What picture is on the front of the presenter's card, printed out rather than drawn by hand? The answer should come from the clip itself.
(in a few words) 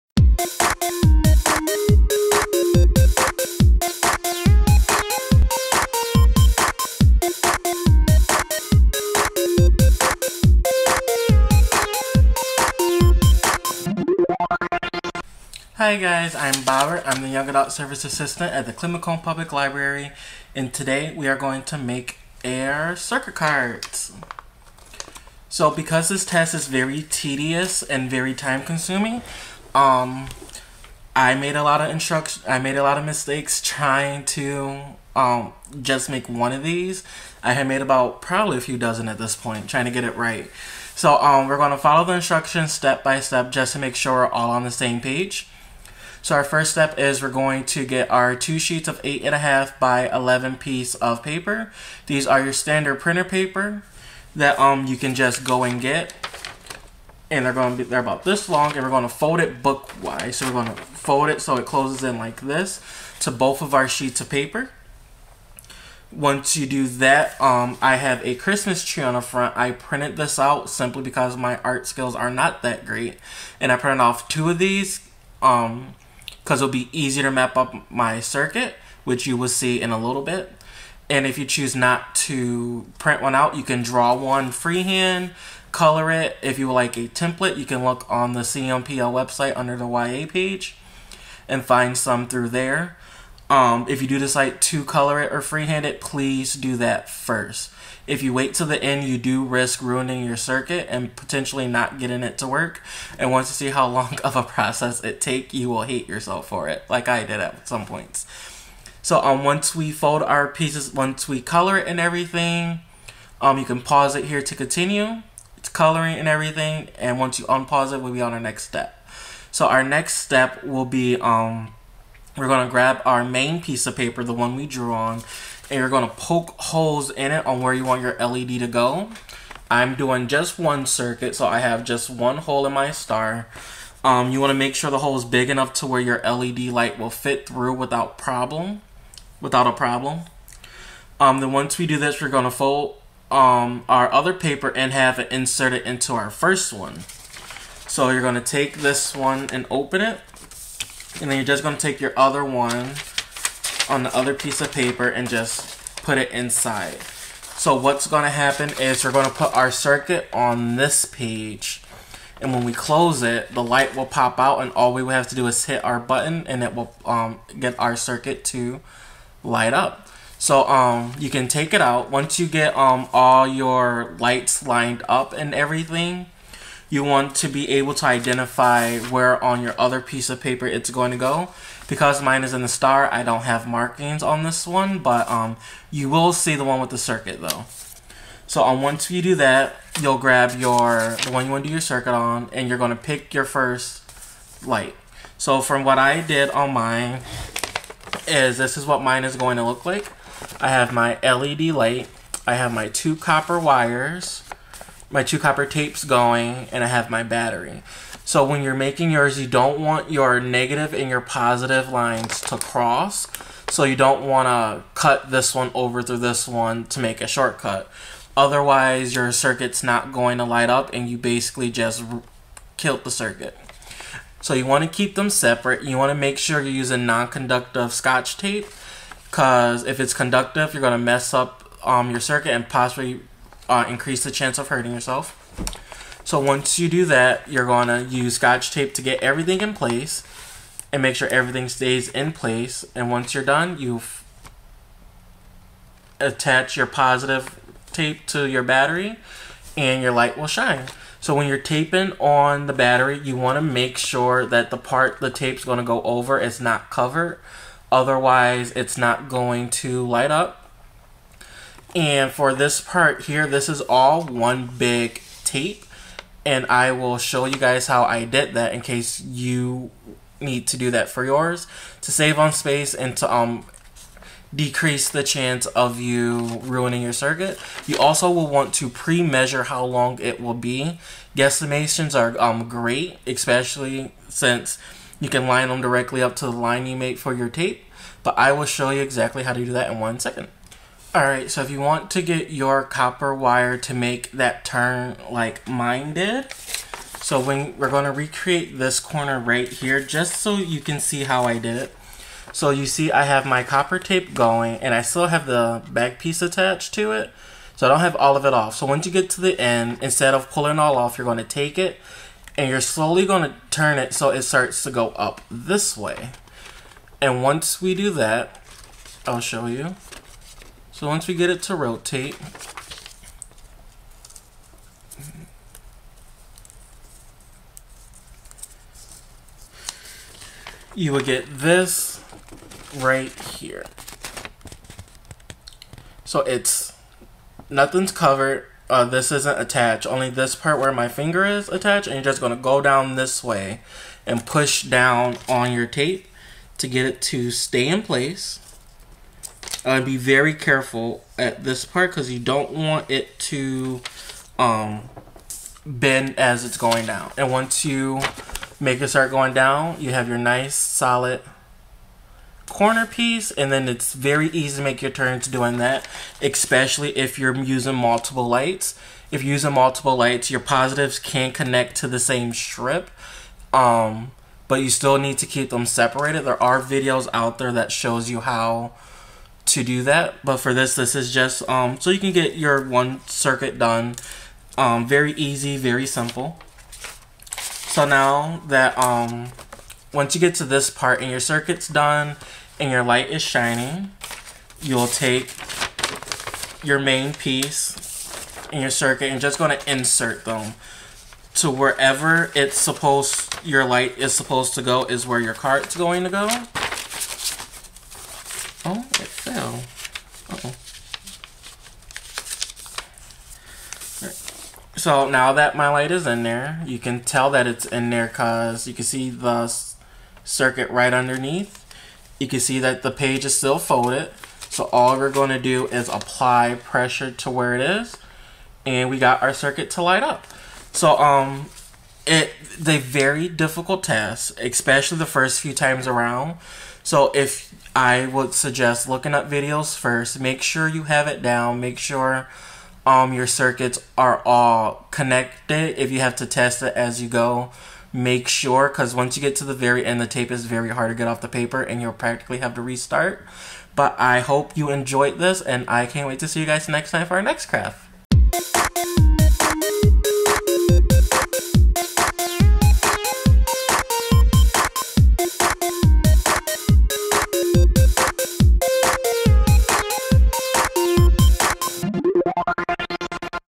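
Christmas tree.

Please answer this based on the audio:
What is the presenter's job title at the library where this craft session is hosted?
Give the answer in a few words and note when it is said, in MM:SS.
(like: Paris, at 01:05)
Young Adult Service Assistant, at 00:17.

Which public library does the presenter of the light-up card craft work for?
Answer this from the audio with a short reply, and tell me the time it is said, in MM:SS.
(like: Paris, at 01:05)
Clinton-Macomb Public Library, at 00:18.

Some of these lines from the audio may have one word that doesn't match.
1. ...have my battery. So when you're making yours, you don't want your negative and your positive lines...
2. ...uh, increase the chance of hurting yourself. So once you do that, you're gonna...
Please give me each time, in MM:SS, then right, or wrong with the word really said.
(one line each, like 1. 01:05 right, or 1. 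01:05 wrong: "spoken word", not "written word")
1. 03:26 right
2. 03:53 right.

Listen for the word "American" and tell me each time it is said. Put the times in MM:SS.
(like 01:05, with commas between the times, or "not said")
not said.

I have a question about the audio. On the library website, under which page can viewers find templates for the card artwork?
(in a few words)
The YA page.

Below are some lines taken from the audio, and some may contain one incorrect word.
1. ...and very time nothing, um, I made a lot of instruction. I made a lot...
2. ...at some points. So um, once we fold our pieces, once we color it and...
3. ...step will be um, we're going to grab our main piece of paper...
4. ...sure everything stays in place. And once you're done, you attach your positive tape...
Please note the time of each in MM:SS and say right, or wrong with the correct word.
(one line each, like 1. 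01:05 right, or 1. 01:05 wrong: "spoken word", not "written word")
1. 00:27 wrong: "consuming", not "nothing"
2. 01:47 right
3. 02:00 right
4. 04:01 right.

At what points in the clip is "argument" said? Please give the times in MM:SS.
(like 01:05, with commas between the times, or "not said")
not said.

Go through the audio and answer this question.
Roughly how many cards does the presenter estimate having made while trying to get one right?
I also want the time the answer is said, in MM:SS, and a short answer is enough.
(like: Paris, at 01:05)
A few dozen, at 00:38.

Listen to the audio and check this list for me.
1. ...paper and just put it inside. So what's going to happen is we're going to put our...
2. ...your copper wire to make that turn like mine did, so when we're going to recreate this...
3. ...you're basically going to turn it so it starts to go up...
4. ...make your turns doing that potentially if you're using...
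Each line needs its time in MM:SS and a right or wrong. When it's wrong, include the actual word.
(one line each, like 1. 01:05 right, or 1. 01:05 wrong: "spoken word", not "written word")
1. 02:34 right
2. 04:52 right
3. 05:12 wrong: "slowly", not "basically"
4. 06:04 wrong: "especially", not "potentially".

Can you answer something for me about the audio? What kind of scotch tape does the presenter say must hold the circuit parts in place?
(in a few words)
Non-conductive.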